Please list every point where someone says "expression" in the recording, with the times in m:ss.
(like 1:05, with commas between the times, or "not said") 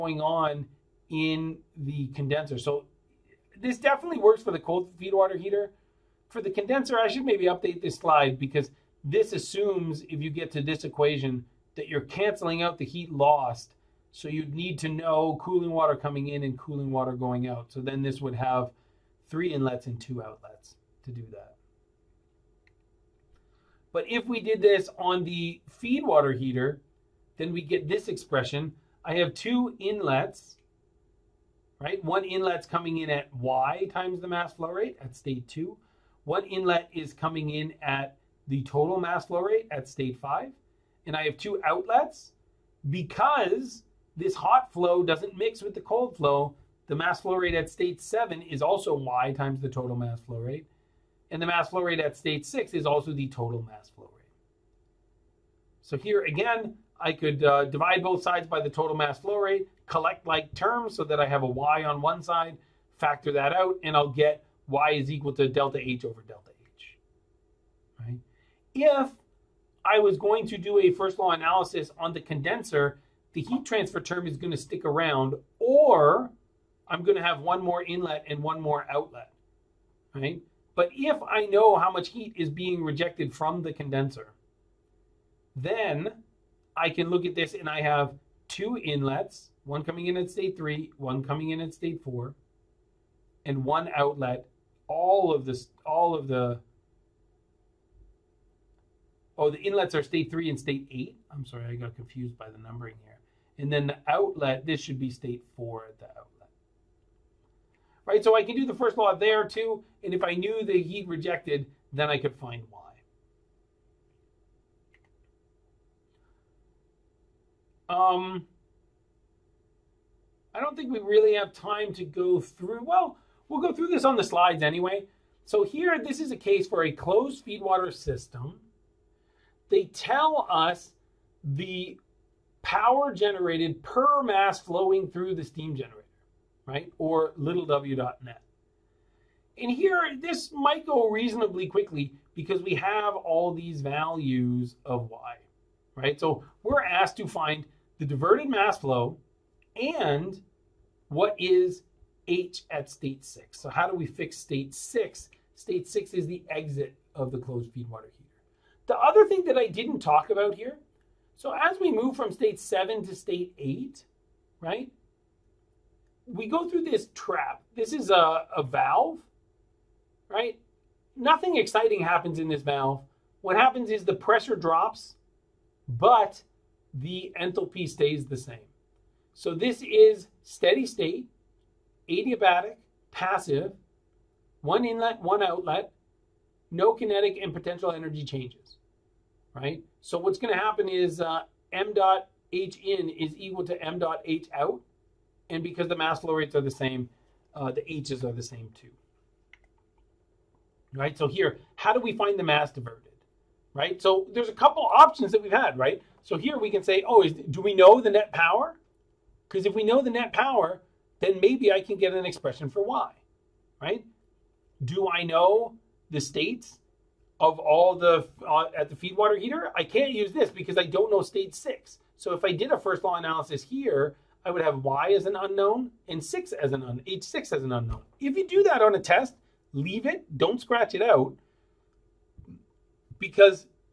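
0:28, 3:32.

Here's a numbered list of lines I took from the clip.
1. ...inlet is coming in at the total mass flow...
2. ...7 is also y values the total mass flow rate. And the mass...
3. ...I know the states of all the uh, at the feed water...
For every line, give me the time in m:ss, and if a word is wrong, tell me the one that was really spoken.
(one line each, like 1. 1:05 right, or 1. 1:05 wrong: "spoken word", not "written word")
1. 0:36 right
2. 0:48 wrong: "times", not "values"
3. 3:35 right.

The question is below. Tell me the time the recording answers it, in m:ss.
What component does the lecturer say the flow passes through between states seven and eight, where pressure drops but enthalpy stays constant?
2:47.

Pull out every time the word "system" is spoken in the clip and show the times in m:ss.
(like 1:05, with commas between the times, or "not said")
2:07.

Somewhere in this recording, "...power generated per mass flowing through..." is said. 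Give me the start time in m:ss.
2:12.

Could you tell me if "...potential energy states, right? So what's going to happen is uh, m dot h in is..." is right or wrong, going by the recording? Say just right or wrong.
wrong.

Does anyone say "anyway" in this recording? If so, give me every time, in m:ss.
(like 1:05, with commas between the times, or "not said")
2:04.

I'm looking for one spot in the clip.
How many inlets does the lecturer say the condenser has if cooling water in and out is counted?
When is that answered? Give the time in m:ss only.
0:19.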